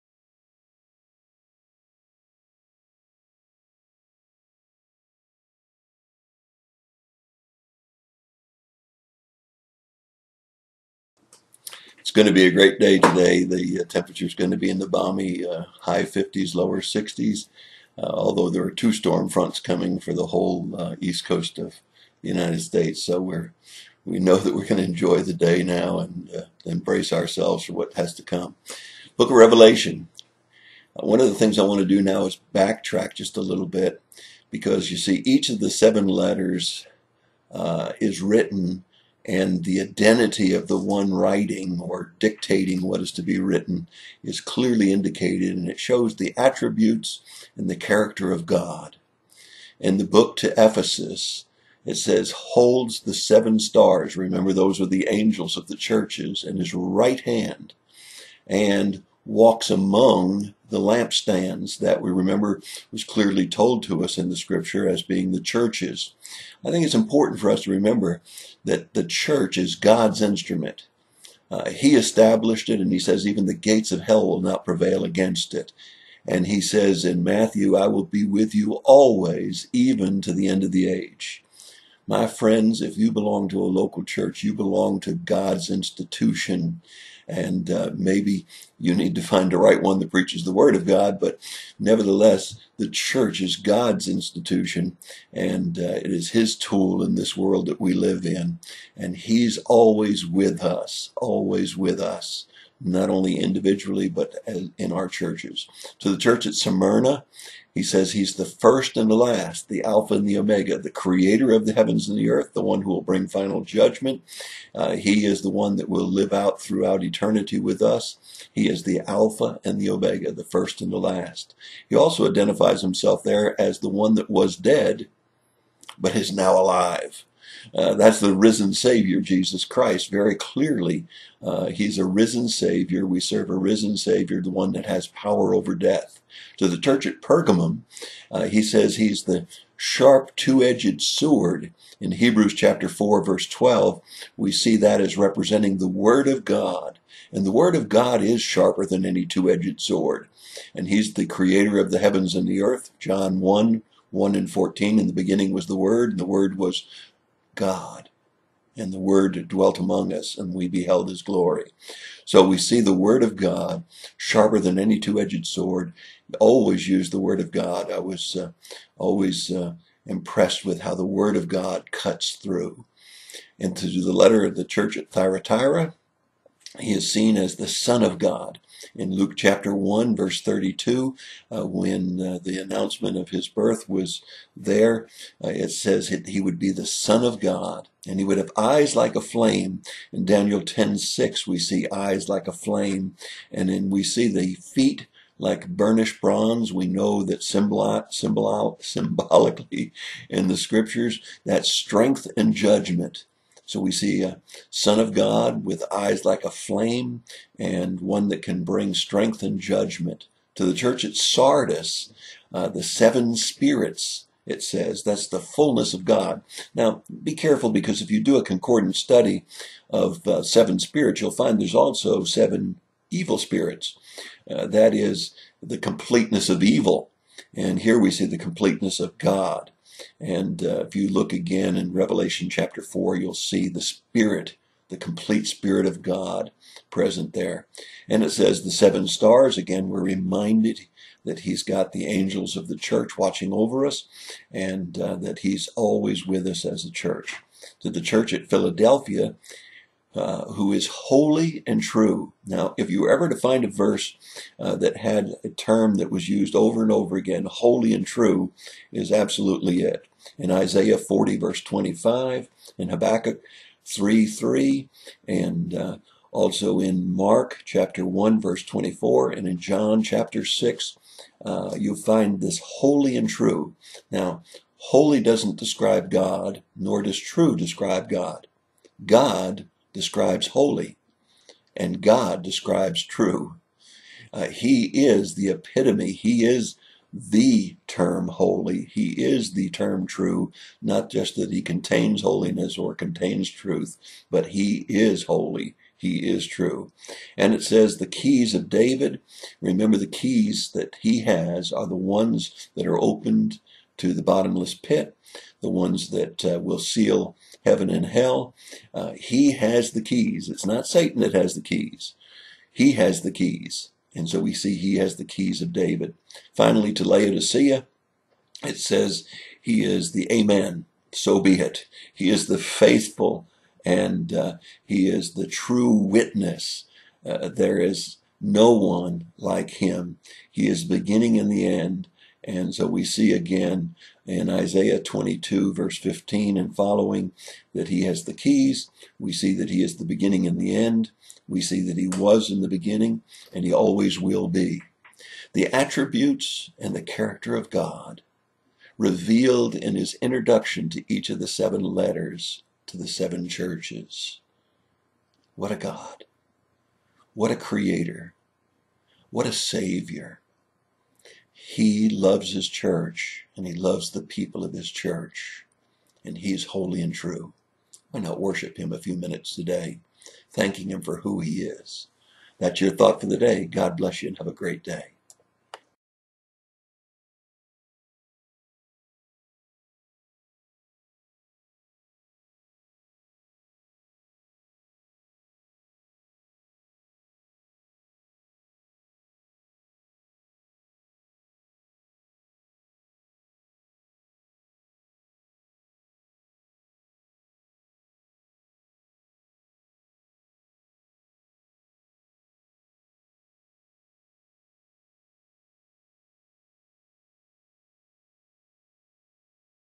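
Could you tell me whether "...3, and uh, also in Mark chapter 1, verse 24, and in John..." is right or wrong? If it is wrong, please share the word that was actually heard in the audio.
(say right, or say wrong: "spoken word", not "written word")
right.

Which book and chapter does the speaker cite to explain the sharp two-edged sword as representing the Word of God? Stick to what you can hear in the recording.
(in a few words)
Hebrews 4.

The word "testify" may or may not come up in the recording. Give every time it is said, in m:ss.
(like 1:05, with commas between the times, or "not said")
not said.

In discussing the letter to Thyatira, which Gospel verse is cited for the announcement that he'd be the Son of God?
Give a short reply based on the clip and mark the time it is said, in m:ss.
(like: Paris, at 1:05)
Luke 1:32, at 2:59.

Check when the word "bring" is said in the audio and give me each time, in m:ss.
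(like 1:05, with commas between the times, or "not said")
1:53, 3:28.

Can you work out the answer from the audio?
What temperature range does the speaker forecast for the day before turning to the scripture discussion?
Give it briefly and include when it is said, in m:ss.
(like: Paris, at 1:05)
high 50s, lower 60s, at 0:15.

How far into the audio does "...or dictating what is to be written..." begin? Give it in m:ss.
0:41.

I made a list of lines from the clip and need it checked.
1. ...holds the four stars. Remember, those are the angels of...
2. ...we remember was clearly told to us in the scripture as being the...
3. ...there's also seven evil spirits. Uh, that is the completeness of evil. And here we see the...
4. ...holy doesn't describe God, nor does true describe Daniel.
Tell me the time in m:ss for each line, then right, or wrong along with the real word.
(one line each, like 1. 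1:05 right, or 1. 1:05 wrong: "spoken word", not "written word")
1. 0:52 wrong: "seven", not "four"
2. 1:02 right
3. 3:41 right
4. 4:34 wrong: "God", not "Daniel".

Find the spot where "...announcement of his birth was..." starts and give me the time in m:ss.
3:02.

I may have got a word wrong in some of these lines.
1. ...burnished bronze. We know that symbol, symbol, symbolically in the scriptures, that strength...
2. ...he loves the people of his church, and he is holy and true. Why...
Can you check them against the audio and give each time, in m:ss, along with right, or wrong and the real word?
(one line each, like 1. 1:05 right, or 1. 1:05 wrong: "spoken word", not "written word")
1. 3:15 right
2. 6:03 right.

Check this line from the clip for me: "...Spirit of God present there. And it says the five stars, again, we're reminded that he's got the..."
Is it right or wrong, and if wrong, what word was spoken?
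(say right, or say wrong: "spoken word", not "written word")
wrong: "seven", not "five".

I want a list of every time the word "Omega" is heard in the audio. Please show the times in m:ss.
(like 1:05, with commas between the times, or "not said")
1:50, 1:59.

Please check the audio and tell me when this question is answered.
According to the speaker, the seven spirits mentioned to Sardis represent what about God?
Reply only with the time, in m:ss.
3:35.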